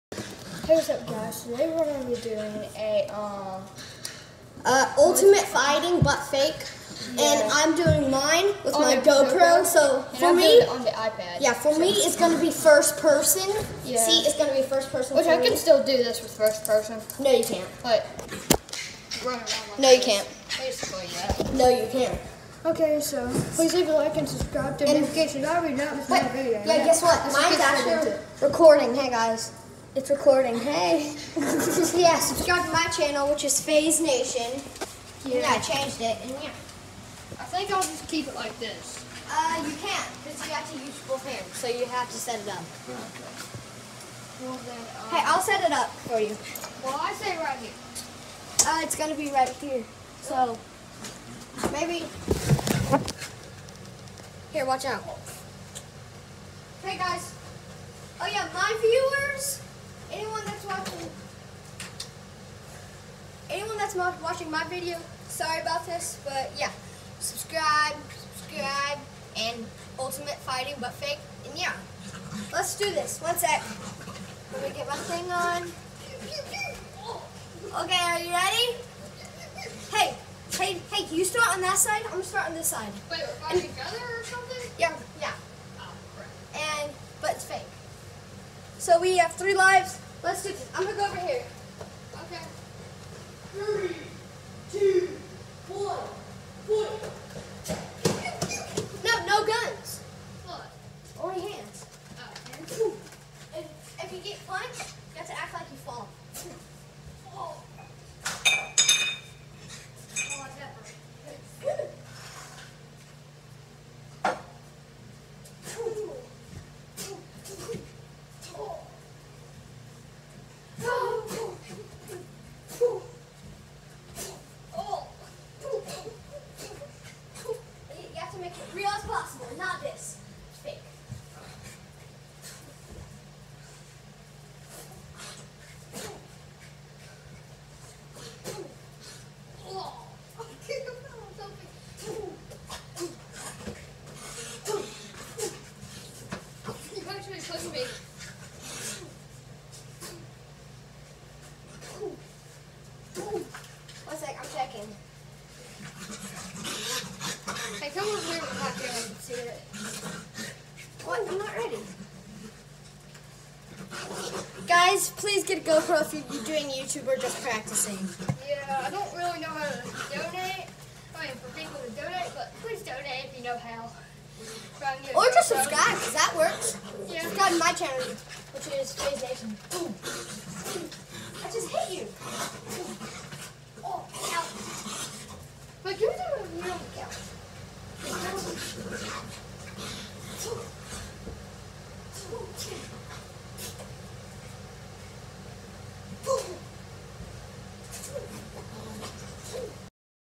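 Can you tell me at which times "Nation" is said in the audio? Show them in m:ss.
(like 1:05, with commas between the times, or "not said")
0:33, 2:59.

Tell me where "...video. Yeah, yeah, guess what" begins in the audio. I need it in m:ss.
0:26.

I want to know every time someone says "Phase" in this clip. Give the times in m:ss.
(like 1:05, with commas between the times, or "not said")
0:33, 2:58.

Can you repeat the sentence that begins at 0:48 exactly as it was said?
Uh, it's gonna be right here.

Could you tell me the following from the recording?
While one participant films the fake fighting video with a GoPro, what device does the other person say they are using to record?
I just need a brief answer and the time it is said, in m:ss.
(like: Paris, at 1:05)
iPad, at 0:10.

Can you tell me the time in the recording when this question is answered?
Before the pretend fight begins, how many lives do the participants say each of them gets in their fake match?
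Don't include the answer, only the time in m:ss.
1:29.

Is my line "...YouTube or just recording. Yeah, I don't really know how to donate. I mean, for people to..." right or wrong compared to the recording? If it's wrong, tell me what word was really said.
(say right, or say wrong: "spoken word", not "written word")
wrong: "practicing", not "recording".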